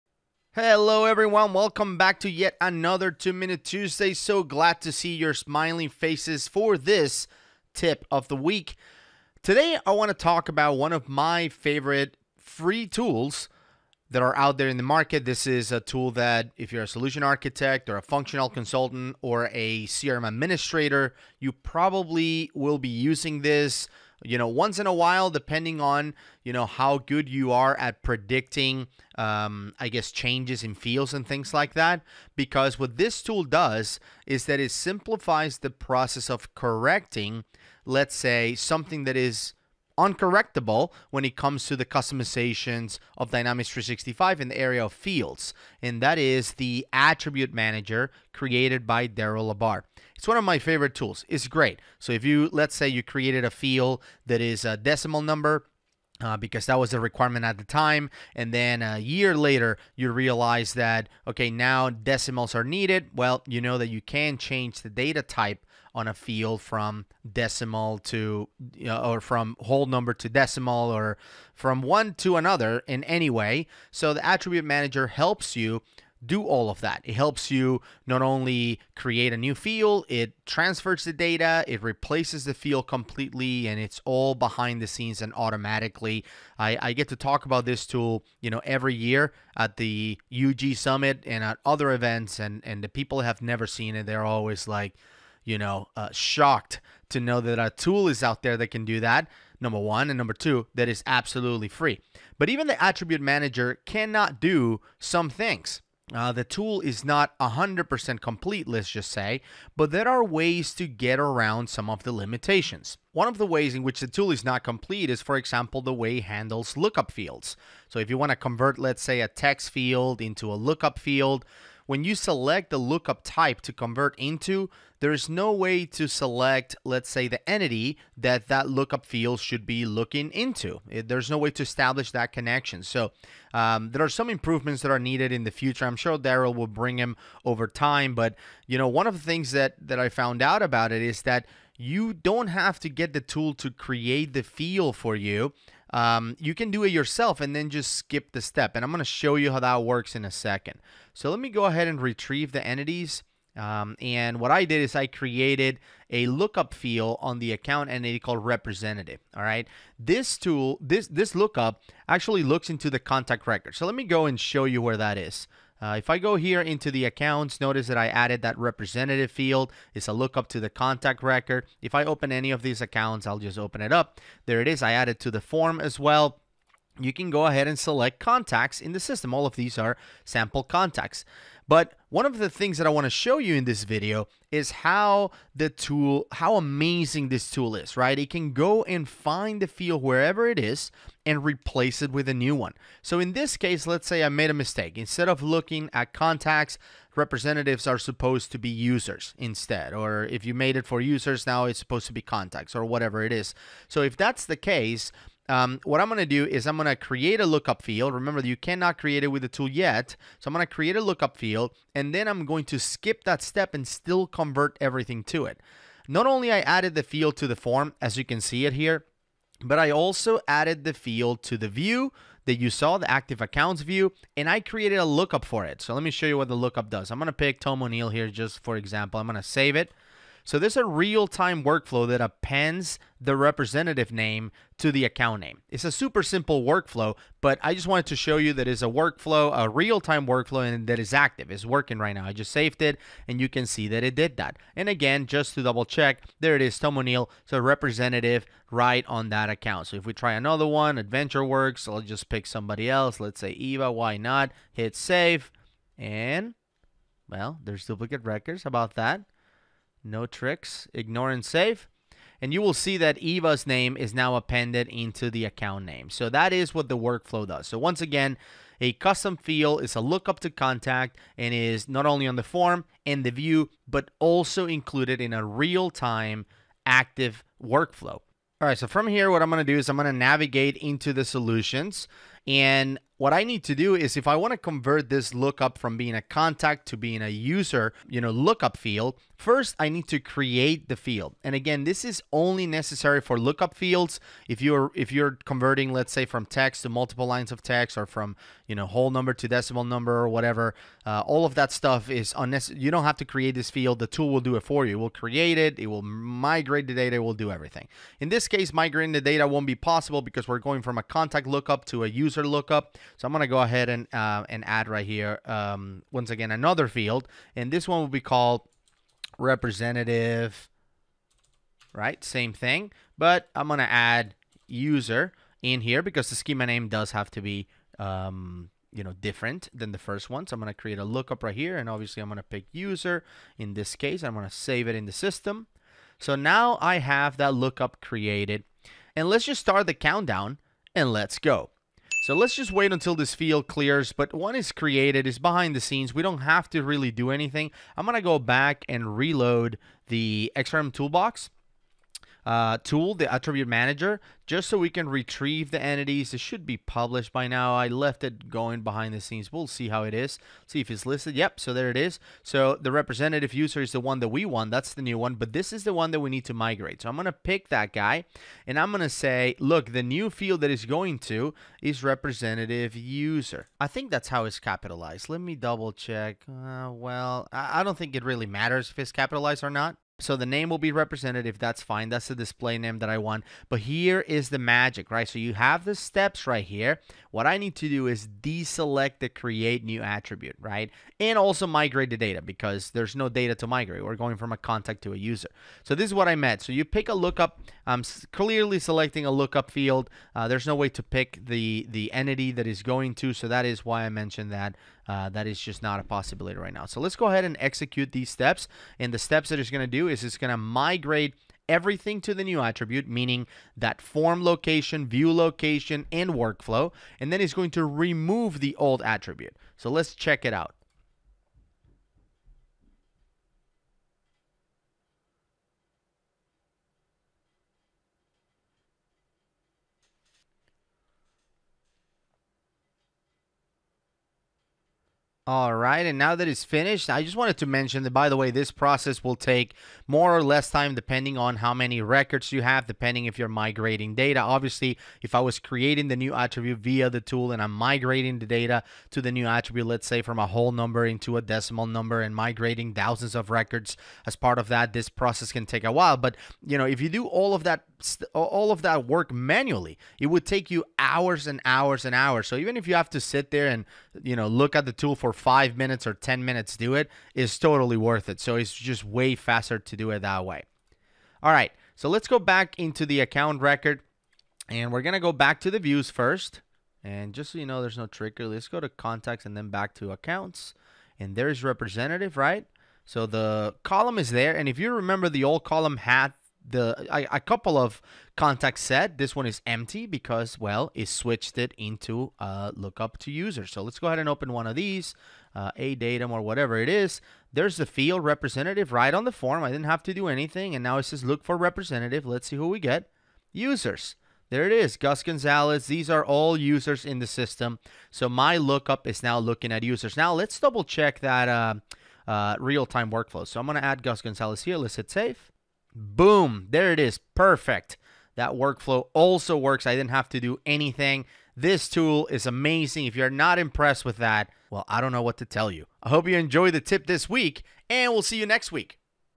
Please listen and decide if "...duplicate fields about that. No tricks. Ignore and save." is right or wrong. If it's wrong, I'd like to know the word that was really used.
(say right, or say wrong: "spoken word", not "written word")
wrong: "records", not "fields".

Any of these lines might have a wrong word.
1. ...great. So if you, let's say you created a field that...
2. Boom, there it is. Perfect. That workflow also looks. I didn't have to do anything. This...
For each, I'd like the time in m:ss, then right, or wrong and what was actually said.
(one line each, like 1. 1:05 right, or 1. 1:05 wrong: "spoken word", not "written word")
1. 0:51 right
2. 8:35 wrong: "works", not "looks".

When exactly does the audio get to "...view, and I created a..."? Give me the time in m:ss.
3:43.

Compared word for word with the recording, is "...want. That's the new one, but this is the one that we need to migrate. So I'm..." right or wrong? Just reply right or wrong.
right.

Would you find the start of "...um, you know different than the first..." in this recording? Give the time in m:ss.
5:27.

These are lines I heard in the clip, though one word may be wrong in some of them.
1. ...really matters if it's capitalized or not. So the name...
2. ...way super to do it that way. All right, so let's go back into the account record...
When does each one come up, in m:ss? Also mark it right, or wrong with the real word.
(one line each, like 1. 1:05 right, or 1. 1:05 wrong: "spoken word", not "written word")
1. 6:18 right
2. 7:49 wrong: "faster", not "super".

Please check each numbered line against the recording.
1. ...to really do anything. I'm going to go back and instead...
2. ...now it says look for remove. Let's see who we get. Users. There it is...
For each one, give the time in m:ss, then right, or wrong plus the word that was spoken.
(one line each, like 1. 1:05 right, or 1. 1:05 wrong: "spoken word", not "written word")
1. 5:46 wrong: "reload", not "instead"
2. 8:20 wrong: "representative", not "remove".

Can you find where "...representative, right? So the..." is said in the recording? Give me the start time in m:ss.
8:01.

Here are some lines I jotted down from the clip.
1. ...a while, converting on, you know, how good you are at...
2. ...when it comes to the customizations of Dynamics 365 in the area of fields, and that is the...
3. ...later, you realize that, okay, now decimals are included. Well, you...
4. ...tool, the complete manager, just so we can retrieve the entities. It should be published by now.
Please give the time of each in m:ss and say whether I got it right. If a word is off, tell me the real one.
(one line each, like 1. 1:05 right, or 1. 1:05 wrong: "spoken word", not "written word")
1. 0:24 wrong: "depending", not "converting"
2. 0:41 right
3. 0:59 wrong: "needed", not "included"
4. 5:52 wrong: "attribute", not "complete".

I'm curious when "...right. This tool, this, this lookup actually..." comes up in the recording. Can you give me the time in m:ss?
2:39.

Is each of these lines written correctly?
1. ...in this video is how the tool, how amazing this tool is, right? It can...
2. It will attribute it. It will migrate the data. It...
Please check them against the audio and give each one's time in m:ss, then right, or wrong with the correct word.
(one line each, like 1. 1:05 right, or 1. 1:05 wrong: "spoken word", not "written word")
1. 3:03 right
2. 5:04 wrong: "create", not "attribute".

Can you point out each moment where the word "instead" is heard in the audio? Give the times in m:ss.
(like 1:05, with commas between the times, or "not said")
3:14, 3:19.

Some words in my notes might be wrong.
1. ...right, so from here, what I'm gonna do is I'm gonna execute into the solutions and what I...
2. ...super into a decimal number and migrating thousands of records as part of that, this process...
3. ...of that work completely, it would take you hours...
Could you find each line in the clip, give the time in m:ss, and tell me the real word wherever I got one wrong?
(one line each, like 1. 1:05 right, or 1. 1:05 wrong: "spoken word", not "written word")
1. 4:38 wrong: "navigate", not "execute"
2. 7:30 wrong: "number", not "super"
3. 7:38 wrong: "manually", not "completely".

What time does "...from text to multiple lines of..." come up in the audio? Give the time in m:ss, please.
4:56.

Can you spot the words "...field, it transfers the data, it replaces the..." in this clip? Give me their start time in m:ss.
1:19.